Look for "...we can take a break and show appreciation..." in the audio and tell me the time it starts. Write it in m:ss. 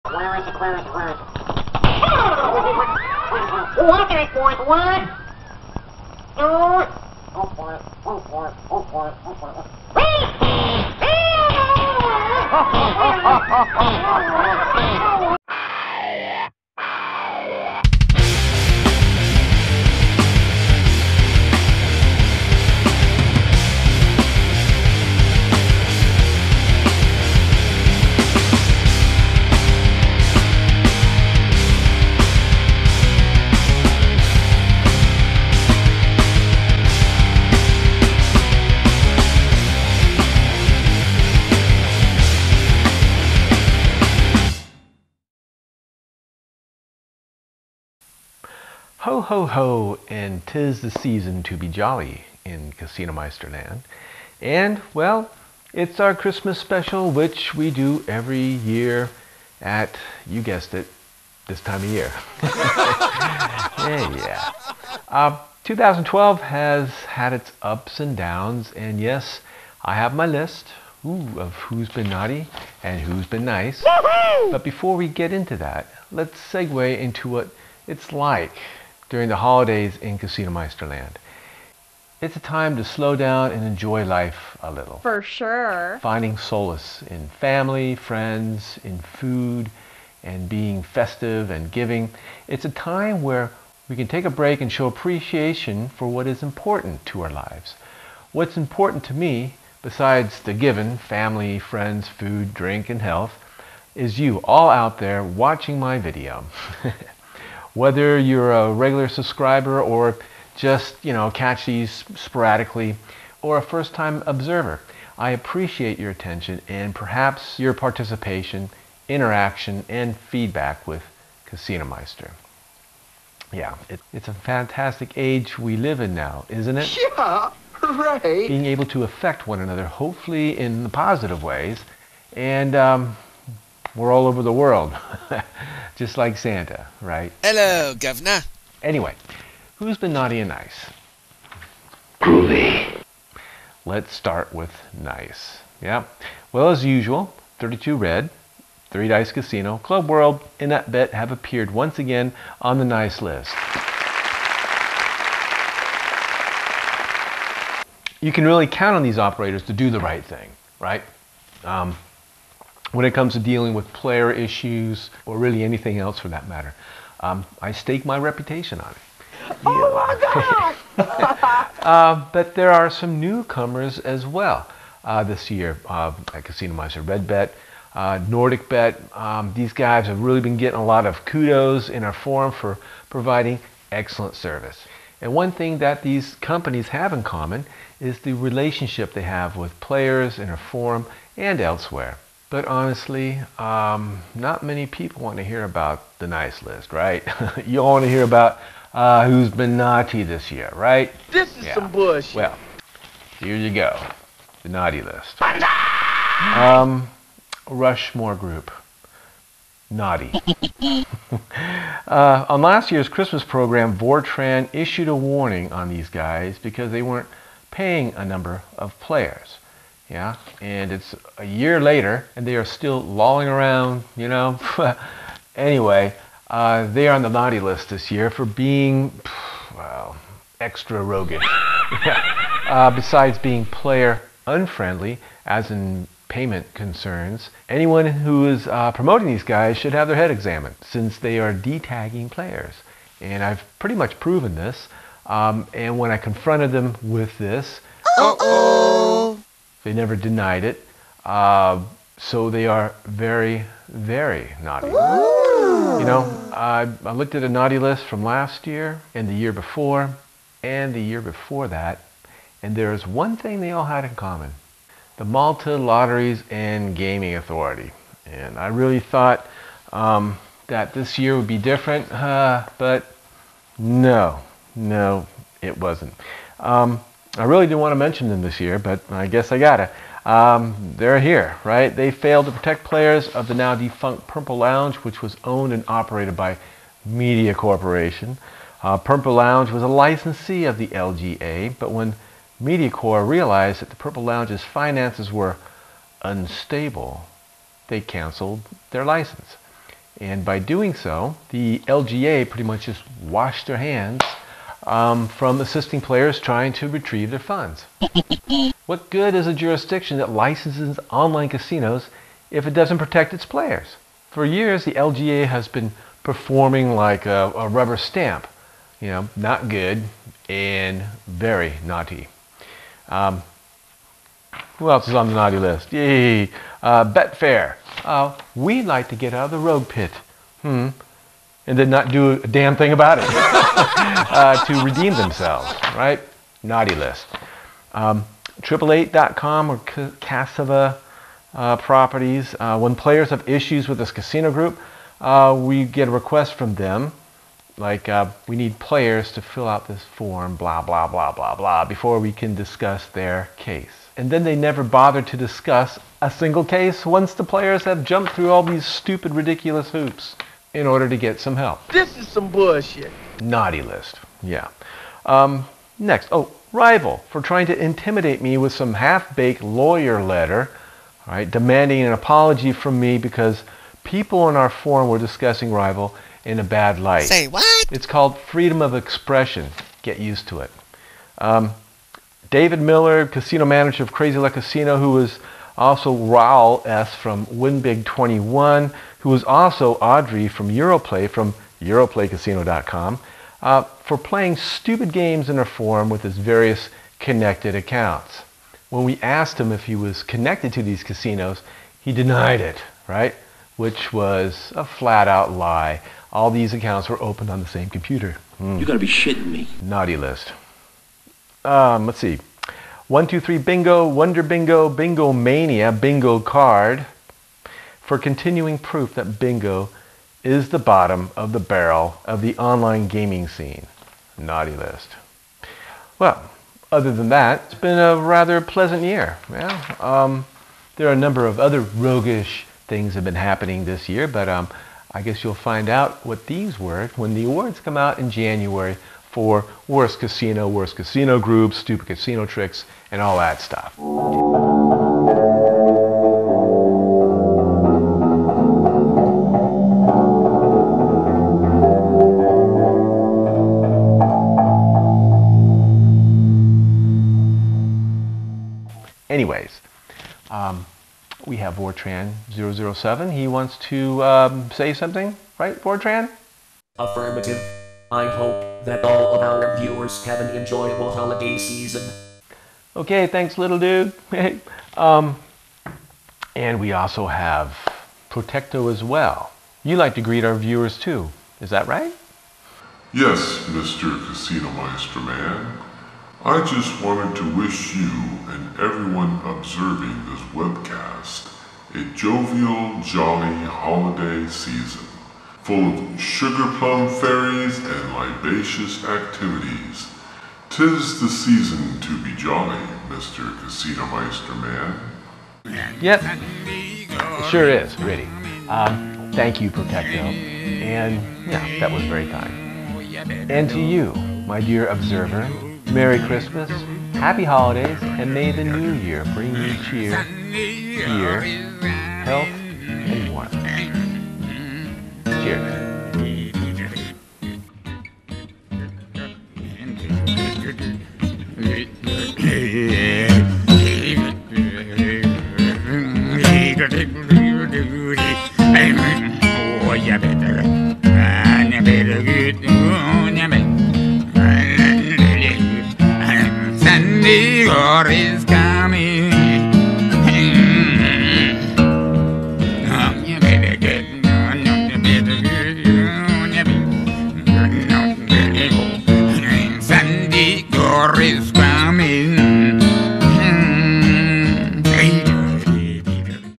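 1:33.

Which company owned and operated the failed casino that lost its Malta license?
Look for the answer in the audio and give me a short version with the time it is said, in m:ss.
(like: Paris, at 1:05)
Media Corporation, at 4:47.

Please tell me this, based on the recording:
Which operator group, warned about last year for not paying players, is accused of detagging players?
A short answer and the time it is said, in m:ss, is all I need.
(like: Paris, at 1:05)
Rushmore Group, at 3:27.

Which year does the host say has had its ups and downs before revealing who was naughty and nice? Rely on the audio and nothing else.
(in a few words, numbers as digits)
2012.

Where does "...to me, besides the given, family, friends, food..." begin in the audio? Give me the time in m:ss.
1:39.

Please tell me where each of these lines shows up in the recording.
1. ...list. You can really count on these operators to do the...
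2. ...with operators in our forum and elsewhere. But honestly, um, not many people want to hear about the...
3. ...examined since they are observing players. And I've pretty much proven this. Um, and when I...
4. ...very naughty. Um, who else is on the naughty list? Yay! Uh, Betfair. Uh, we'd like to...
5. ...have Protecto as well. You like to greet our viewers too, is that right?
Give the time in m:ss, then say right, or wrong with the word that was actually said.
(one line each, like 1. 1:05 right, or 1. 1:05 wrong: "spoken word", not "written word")
1. 2:33 right
2. 3:09 wrong: "players", not "operators"
3. 4:00 wrong: "detagging", not "observing"
4. 5:21 right
5. 7:57 right.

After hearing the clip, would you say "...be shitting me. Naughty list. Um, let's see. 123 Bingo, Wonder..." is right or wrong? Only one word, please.
right.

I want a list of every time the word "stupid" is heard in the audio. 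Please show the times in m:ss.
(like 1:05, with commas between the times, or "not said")
5:58, 6:34, 7:21.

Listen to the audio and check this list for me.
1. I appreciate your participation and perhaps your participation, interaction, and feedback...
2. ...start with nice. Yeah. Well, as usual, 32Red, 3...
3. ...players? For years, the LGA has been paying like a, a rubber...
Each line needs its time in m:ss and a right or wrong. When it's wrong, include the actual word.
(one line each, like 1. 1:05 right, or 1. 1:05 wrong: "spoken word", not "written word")
1. 1:55 wrong: "attention", not "participation"
2. 2:24 right
3. 5:13 wrong: "performing", not "paying".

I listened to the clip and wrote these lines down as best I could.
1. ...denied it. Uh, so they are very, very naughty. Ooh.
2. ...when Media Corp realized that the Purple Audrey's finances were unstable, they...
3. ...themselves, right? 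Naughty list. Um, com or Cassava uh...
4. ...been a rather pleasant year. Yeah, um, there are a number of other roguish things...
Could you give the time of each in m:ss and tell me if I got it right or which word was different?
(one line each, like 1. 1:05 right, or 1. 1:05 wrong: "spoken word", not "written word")
1. 4:10 right
2. 4:51 wrong: "Lounge", not "Audrey"
3. 5:35 right
4. 7:07 right.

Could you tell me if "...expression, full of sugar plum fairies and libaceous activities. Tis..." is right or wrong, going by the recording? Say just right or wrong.
wrong.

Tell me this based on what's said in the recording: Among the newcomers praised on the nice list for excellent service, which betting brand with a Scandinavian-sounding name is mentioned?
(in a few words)
Nordic Bet.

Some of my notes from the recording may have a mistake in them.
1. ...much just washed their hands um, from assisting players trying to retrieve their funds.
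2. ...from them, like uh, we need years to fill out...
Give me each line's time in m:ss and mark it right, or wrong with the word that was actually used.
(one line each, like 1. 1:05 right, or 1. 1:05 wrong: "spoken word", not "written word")
1. 5:02 right
2. 5:46 wrong: "players", not "years".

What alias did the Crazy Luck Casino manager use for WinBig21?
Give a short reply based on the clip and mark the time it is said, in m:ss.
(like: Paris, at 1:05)
Raul S., at 6:26.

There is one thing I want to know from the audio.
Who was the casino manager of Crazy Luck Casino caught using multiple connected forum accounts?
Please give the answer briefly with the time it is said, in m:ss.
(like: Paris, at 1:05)
David Miller, at 6:22.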